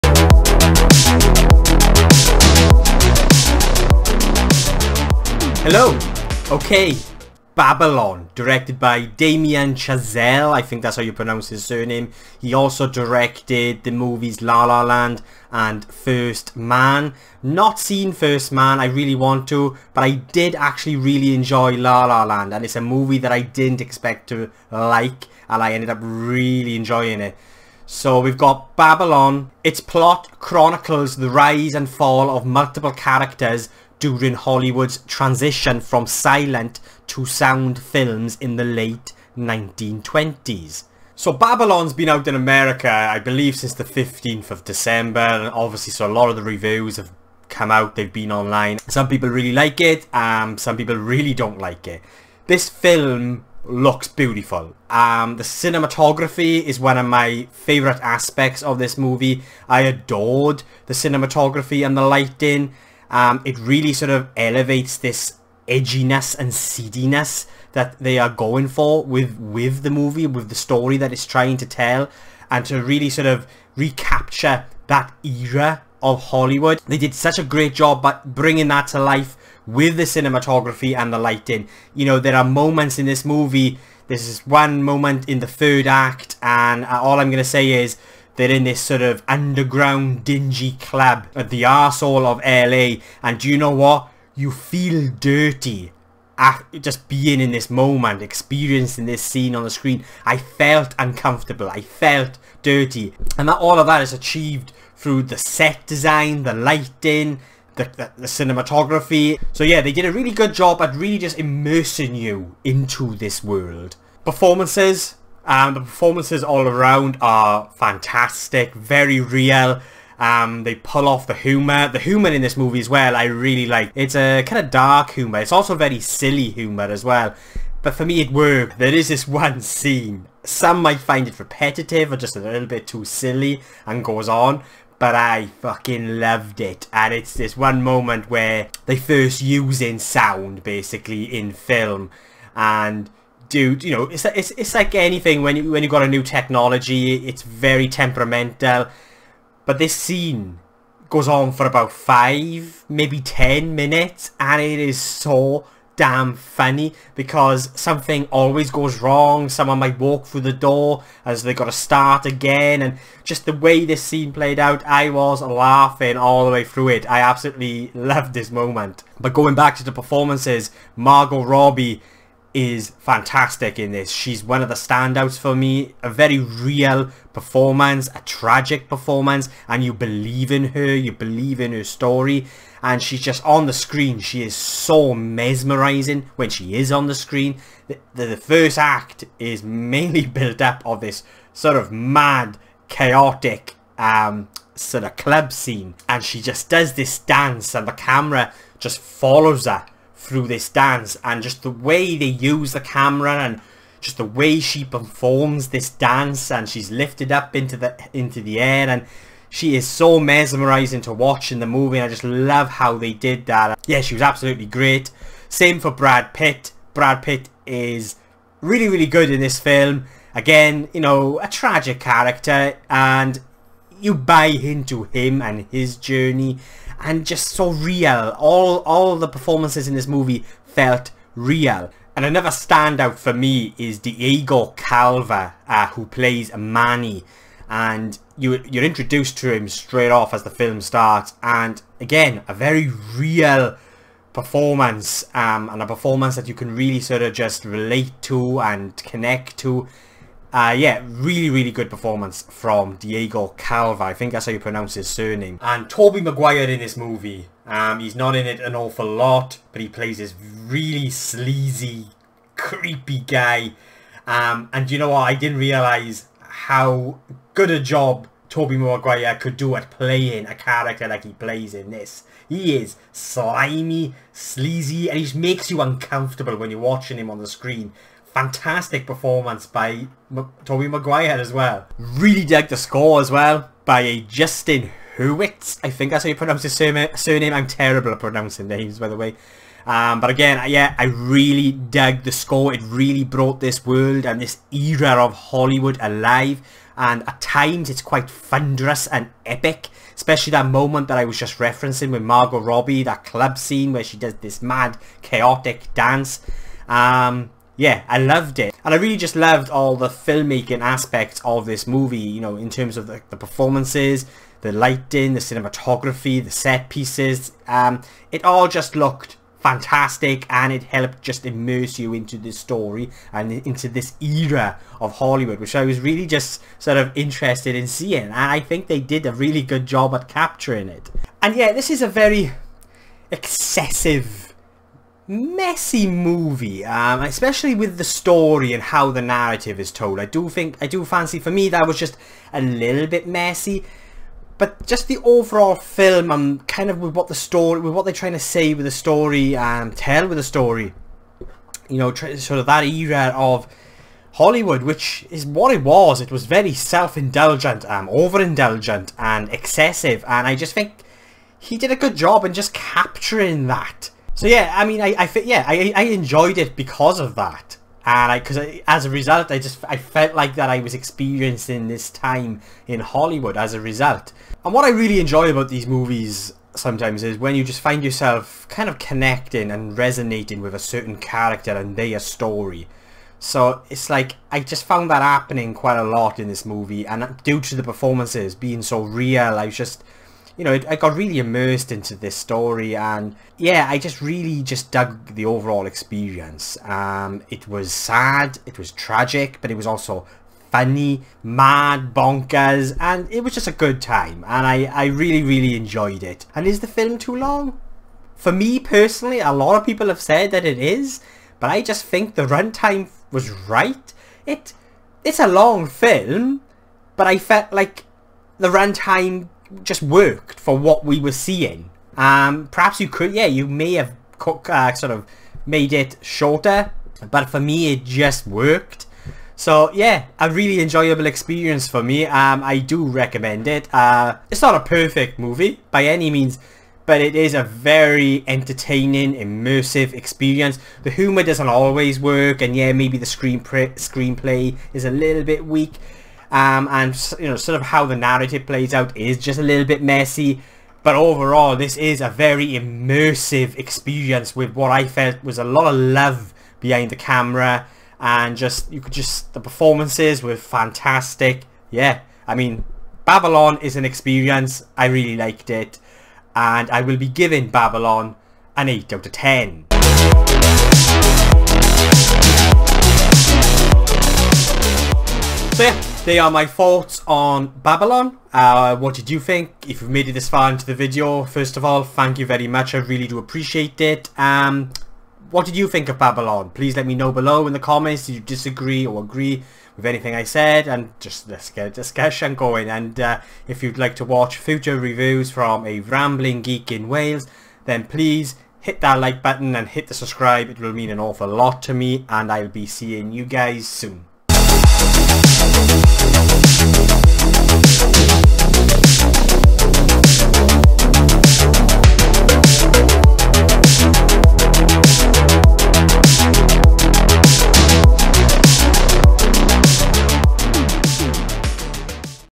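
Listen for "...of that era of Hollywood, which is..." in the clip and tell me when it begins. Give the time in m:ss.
5:52.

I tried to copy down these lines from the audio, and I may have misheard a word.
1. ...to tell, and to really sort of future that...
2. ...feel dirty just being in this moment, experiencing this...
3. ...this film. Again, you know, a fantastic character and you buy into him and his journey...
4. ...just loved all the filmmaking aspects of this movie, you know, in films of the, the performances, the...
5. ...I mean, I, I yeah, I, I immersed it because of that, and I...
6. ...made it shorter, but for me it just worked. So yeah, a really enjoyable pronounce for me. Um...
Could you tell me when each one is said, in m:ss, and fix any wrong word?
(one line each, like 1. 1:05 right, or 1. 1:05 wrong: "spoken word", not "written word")
1. 1:11 wrong: "recapture", not "future"
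2. 1:34 right
3. 3:39 wrong: "tragic", not "fantastic"
4. 5:09 wrong: "terms", not "films"
5. 6:04 wrong: "enjoyed", not "immersed"
6. 7:05 wrong: "experience", not "pronounce".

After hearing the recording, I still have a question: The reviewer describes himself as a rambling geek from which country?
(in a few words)
Wales.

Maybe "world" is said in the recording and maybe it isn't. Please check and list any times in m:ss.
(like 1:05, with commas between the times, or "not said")
1:53, 4:53.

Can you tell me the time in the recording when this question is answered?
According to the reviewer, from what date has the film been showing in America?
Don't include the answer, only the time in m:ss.
0:43.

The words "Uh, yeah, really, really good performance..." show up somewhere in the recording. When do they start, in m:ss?
4:10.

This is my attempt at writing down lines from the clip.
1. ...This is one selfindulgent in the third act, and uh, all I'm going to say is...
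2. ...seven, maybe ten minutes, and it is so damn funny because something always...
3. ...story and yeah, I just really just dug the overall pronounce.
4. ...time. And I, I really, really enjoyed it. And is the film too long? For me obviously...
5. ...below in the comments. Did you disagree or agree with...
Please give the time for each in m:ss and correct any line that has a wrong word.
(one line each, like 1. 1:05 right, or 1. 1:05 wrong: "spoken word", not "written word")
1. 1:24 wrong: "moment", not "selfindulgent"
2. 2:31 wrong: "five", not "seven"
3. 6:32 wrong: "experience", not "pronounce"
4. 6:44 wrong: "personally", not "obviously"
5. 8:07 right.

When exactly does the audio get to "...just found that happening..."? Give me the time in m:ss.
6:24.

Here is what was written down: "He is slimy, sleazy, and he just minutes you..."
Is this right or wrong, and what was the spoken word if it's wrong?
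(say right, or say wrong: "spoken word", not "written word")
wrong: "makes", not "minutes".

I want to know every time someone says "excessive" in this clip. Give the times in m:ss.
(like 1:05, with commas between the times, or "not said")
5:33, 5:59.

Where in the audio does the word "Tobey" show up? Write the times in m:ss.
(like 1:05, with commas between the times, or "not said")
4:15, 4:28, 4:40.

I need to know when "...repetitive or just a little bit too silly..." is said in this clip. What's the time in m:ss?
2:11.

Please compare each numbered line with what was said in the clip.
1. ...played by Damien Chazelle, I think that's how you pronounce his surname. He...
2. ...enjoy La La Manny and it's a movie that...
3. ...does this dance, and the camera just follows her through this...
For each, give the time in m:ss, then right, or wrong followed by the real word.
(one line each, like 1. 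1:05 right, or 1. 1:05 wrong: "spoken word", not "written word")
1. 0:08 wrong: "directed", not "played"
2. 0:21 wrong: "Land", not "Manny"
3. 3:16 right.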